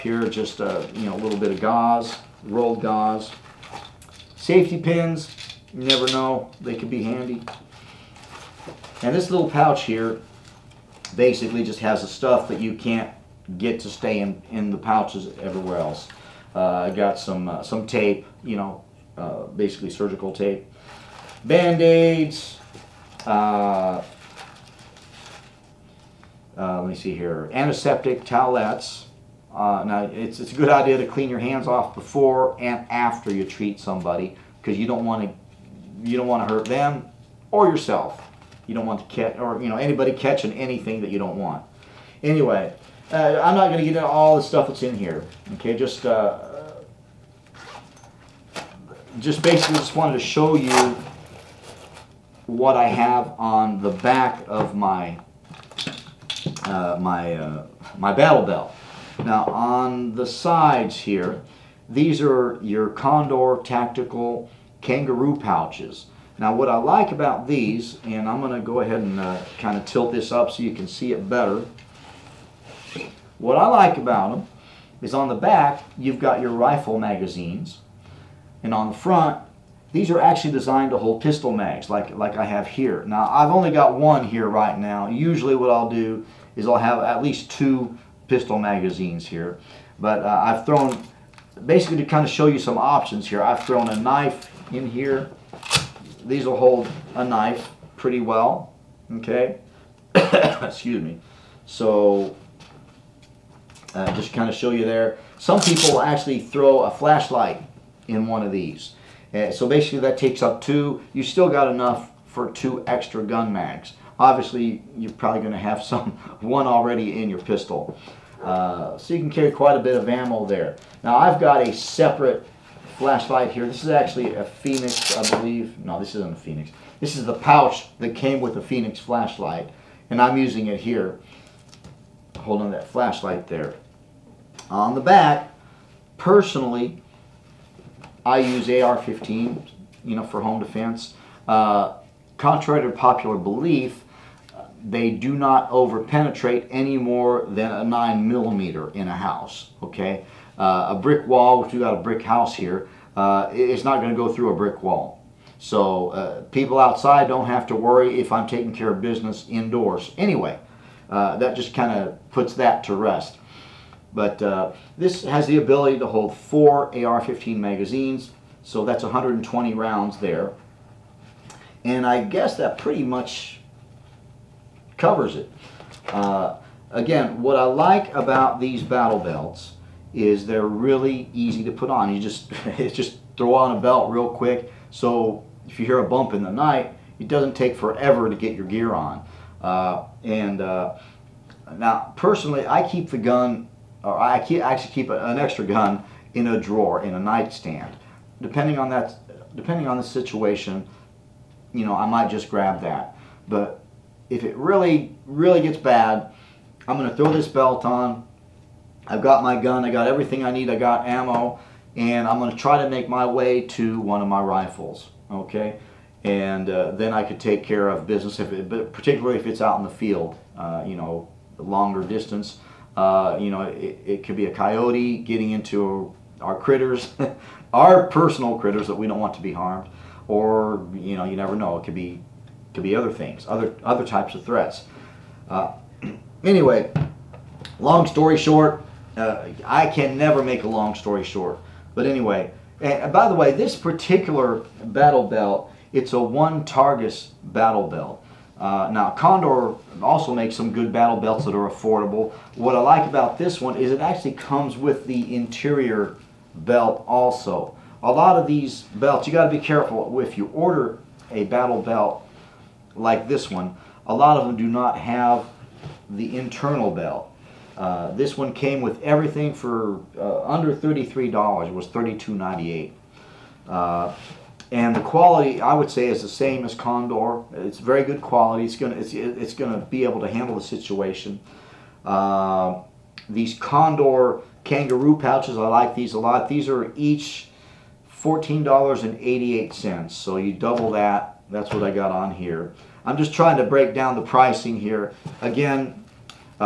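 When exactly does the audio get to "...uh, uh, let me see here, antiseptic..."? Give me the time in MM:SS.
00:23.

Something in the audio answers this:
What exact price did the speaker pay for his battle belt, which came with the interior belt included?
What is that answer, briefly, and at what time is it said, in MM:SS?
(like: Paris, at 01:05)
$32.98, at 04:31.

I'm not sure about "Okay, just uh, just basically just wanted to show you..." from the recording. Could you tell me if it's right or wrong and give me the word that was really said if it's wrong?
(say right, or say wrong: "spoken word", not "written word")
right.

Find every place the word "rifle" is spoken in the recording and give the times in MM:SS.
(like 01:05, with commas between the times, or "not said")
01:16, 03:34.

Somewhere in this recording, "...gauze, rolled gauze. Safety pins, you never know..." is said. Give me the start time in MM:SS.
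00:01.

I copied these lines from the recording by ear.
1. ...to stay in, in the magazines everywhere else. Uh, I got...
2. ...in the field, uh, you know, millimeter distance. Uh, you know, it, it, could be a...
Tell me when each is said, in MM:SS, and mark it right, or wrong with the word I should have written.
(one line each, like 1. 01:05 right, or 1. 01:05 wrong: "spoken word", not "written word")
1. 00:13 wrong: "pouches", not "magazines"
2. 03:39 wrong: "longer", not "millimeter".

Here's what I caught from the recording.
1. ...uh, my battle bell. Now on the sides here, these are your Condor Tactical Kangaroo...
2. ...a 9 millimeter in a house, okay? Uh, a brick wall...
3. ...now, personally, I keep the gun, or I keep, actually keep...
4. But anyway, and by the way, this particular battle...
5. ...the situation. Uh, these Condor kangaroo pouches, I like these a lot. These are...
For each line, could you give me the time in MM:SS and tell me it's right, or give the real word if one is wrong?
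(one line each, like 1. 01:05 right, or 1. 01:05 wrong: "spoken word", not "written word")
1. 00:57 right
2. 02:27 right
3. 03:11 right
4. 04:01 right
5. 04:40 right.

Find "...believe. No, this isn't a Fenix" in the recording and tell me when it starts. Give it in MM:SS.
02:05.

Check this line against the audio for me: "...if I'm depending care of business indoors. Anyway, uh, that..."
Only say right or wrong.
wrong.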